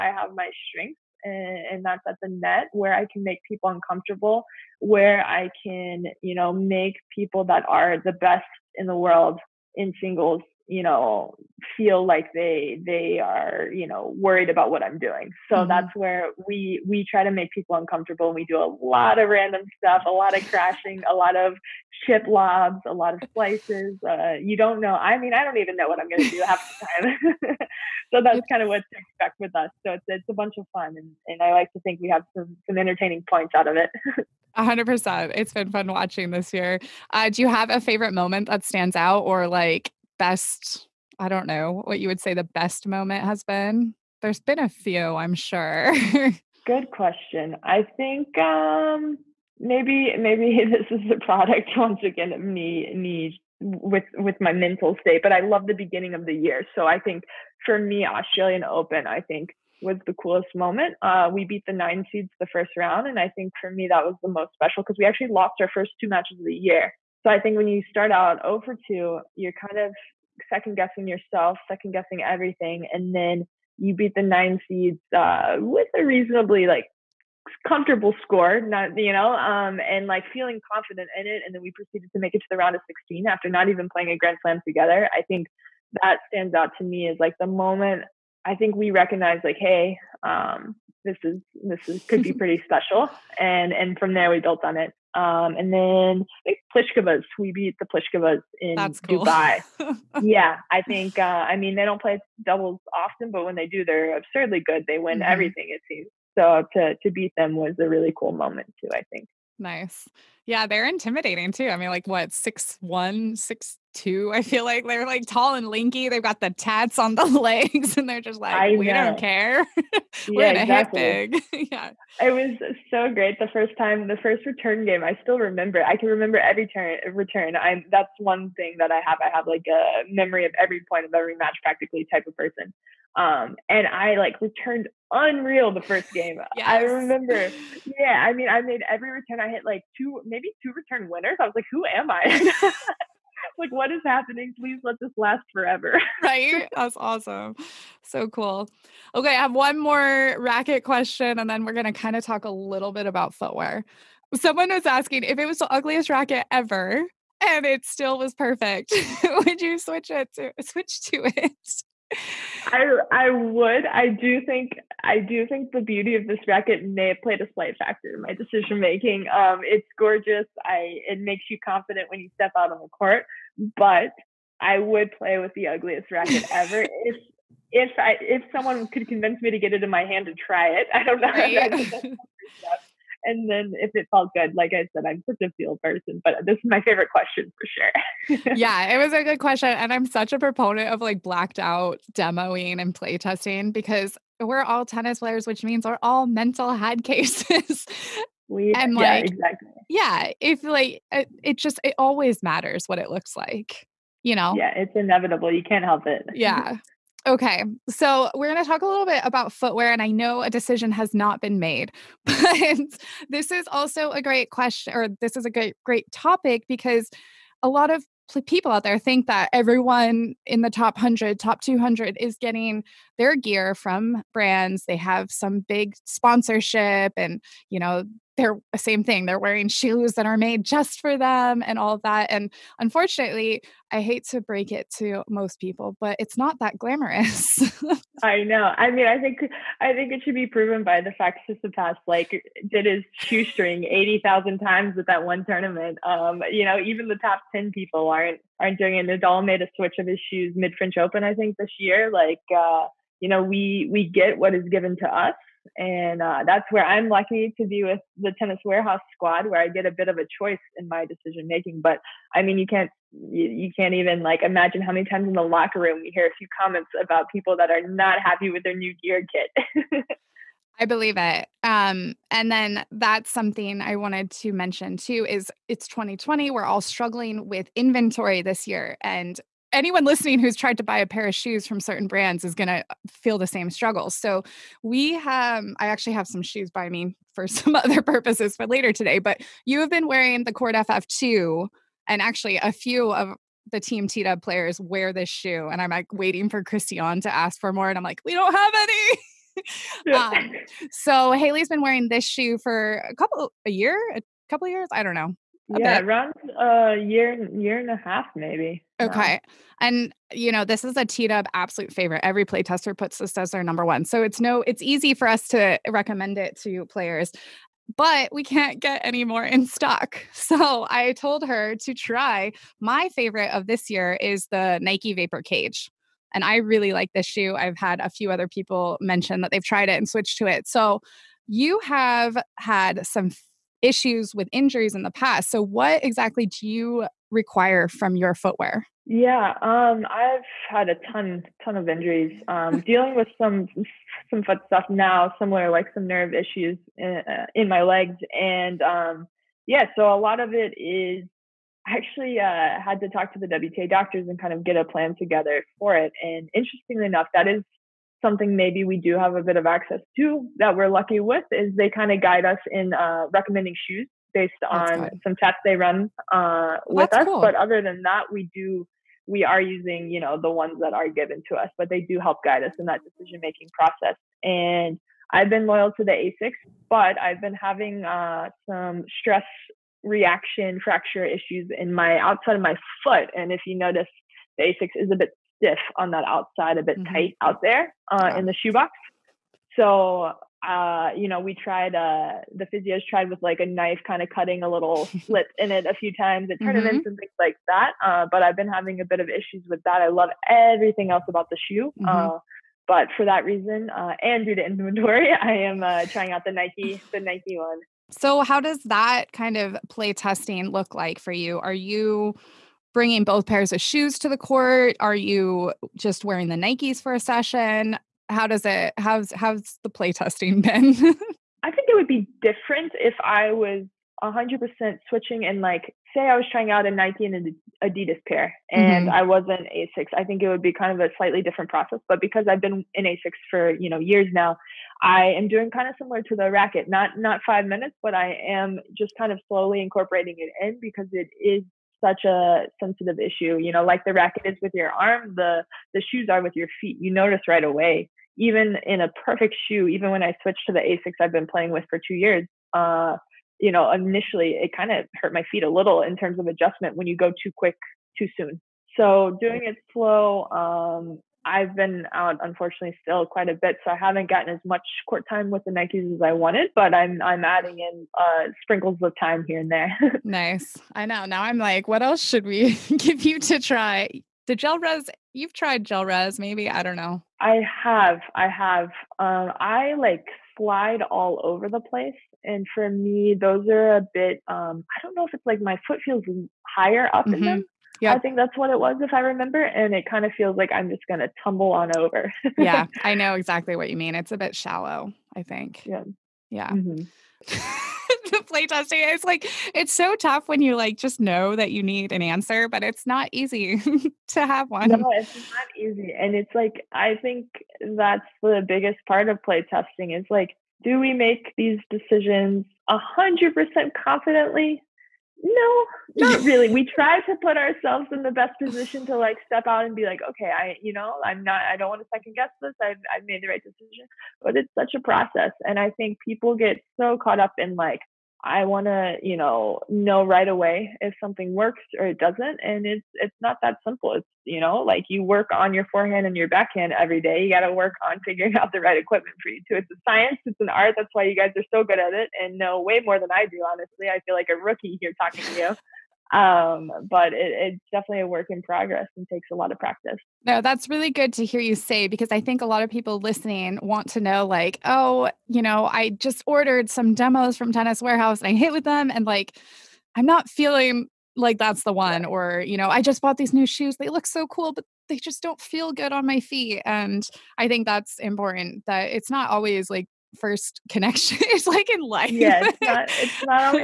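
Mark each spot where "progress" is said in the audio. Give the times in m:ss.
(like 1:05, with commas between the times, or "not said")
9:08.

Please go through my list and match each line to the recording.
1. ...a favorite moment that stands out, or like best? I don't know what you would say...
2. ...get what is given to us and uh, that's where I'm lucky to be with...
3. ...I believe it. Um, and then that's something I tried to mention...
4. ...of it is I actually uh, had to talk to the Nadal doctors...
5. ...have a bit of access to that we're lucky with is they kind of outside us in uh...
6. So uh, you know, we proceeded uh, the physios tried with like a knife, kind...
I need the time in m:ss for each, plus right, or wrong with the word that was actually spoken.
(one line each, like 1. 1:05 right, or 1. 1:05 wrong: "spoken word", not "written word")
1. 0:37 right
2. 4:14 right
3. 4:30 wrong: "wanted", not "tried"
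4. 5:50 wrong: "WTA", not "Nadal"
5. 5:59 wrong: "guide", not "outside"
6. 6:29 wrong: "tried", not "proceeded".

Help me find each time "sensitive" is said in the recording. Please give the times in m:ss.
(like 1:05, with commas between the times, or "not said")
7:22.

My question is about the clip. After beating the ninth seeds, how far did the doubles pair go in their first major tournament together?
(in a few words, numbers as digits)
Round of 16.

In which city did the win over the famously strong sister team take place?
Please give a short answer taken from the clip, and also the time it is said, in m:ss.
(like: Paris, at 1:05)
Dubai, at 1:39.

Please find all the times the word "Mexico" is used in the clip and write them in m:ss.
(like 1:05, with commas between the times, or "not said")
not said.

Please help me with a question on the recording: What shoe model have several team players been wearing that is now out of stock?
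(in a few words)
Court FF2.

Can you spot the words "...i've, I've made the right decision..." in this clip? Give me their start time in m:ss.
8:42.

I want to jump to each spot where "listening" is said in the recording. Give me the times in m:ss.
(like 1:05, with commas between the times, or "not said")
4:40, 9:13.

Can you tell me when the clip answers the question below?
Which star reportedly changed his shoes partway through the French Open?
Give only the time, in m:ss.
4:09.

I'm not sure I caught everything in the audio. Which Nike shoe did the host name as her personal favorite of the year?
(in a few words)
Vapor Cage.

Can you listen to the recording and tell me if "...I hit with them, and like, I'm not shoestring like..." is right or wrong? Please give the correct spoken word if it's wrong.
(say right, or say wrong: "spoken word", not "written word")
wrong: "feeling", not "shoestring".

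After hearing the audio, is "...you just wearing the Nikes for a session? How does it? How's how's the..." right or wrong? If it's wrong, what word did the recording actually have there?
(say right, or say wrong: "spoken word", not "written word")
right.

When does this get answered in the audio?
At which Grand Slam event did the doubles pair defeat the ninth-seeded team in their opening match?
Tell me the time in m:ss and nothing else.
0:58.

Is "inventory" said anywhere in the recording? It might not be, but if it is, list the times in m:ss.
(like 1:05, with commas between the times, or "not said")
4:37, 6:44.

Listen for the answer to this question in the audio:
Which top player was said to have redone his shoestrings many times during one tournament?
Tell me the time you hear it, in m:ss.
4:01.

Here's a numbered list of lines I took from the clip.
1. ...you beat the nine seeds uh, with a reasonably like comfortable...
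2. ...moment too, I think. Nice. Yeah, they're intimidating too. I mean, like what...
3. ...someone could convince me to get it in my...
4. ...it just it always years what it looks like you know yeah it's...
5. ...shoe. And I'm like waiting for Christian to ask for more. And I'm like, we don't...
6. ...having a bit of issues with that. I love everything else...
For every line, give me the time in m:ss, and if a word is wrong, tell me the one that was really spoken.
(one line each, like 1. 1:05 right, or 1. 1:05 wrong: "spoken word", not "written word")
1. 1:13 right
2. 1:48 right
3. 2:58 right
4. 3:21 wrong: "matters", not "years"
5. 4:55 right
6. 6:38 right.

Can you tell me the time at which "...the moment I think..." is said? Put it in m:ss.
1:27.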